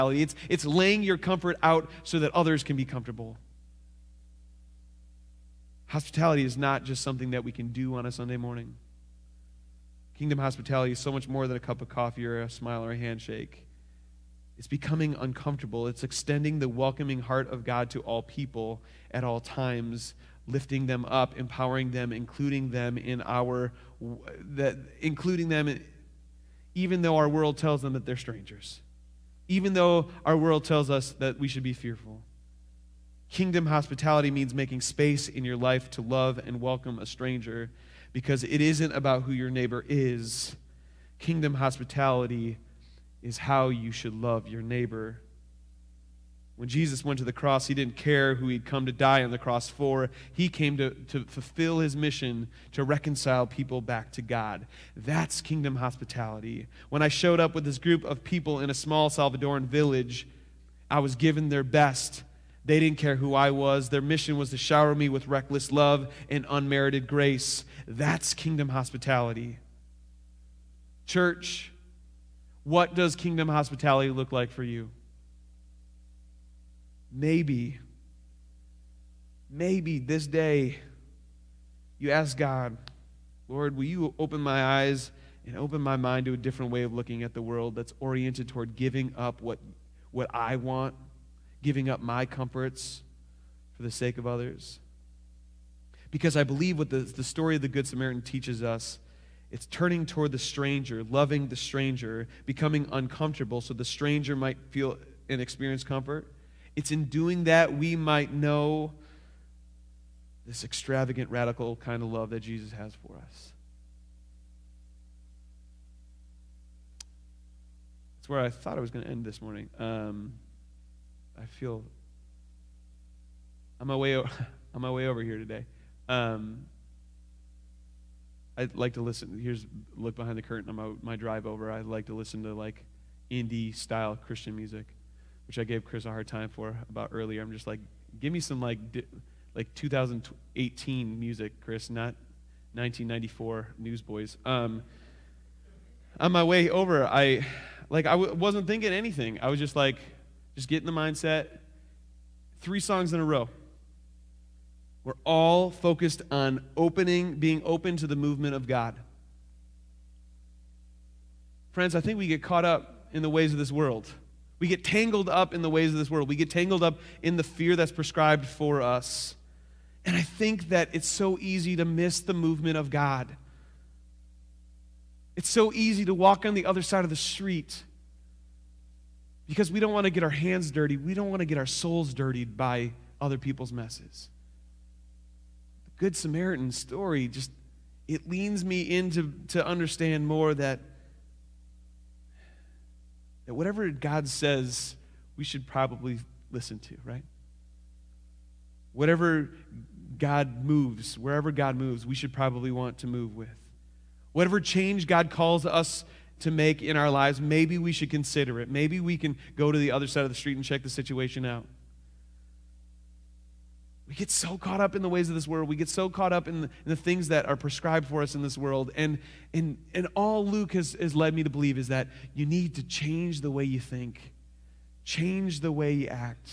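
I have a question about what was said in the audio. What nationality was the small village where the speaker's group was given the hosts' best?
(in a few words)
Salvadoran.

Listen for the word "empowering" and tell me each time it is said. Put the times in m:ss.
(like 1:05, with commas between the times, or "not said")
0:21.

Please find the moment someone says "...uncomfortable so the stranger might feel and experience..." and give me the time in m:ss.
1:42.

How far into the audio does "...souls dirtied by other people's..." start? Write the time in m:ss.
3:01.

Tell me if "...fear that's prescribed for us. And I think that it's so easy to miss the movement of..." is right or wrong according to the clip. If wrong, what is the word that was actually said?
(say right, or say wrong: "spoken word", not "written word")
right.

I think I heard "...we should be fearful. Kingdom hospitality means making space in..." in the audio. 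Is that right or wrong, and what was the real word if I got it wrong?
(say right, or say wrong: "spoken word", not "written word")
right.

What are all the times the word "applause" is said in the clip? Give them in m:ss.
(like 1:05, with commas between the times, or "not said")
not said.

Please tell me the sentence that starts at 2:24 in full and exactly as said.
Um, on my way over, I like I w- wasn't thinking anything.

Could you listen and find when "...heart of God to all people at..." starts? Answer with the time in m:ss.
0:17.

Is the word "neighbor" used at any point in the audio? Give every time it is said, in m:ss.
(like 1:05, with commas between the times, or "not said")
0:39, 0:44.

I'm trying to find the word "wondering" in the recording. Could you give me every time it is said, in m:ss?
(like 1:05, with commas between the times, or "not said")
not said.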